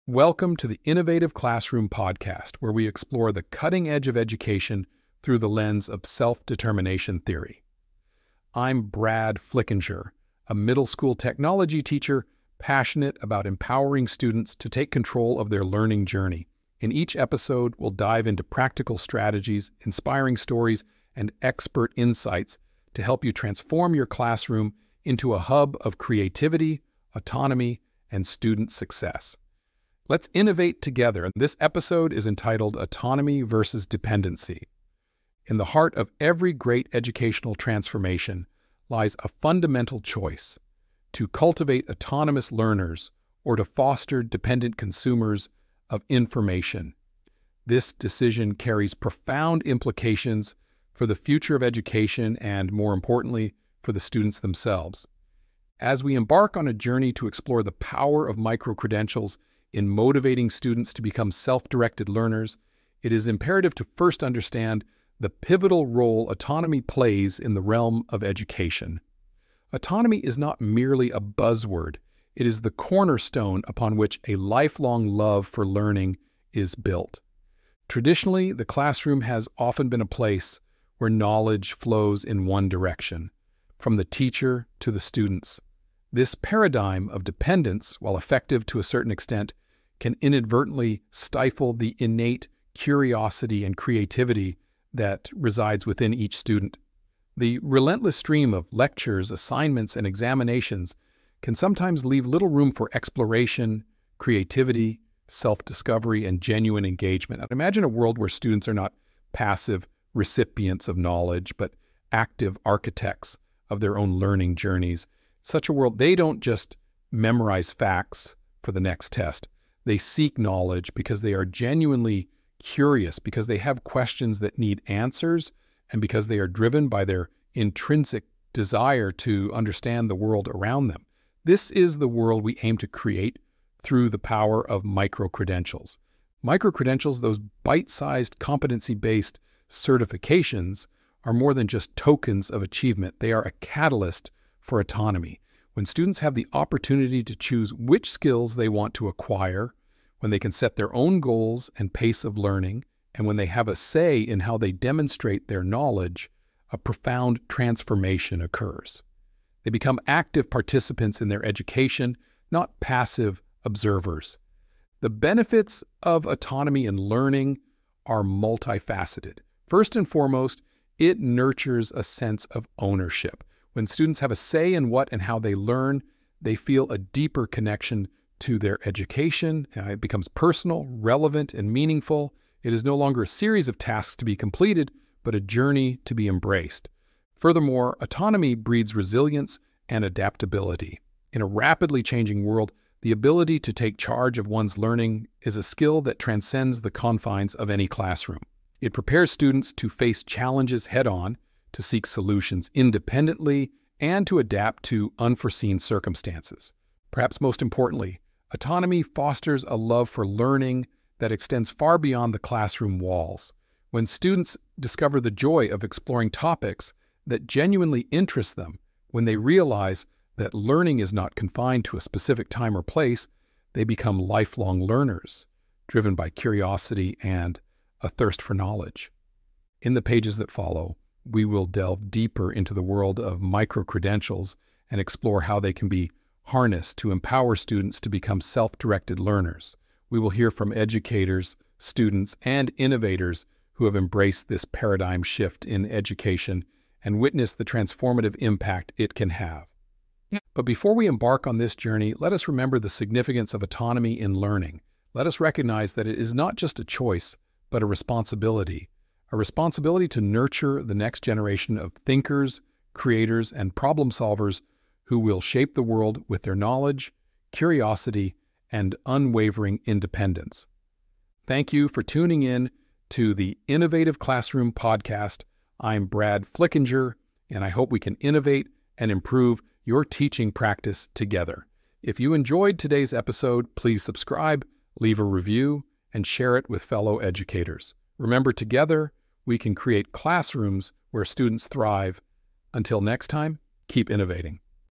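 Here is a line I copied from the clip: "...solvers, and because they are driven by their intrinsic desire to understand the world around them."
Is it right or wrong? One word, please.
wrong.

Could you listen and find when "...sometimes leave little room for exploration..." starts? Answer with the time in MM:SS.
01:41.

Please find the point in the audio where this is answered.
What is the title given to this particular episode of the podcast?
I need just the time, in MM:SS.
00:32.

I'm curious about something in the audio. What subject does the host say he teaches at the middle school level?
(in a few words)
Technology.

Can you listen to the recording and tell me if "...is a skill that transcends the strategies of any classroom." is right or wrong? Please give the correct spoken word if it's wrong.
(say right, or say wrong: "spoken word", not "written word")
wrong: "confines", not "strategies".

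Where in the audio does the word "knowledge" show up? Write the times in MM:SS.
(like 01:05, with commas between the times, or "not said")
01:21, 01:50, 02:00, 02:35, 03:48, 04:26.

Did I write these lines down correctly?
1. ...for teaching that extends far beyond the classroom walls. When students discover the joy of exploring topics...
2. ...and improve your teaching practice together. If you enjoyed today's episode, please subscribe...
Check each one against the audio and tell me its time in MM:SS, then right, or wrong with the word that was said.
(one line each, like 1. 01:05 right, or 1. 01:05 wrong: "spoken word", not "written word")
1. 03:30 wrong: "learning", not "teaching"
2. 04:38 right.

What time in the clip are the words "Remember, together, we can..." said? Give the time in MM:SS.
04:48.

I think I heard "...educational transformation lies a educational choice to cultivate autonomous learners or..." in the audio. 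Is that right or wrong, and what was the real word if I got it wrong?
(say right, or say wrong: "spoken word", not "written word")
wrong: "fundamental", not "educational".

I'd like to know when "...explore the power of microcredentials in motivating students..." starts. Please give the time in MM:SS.
00:57.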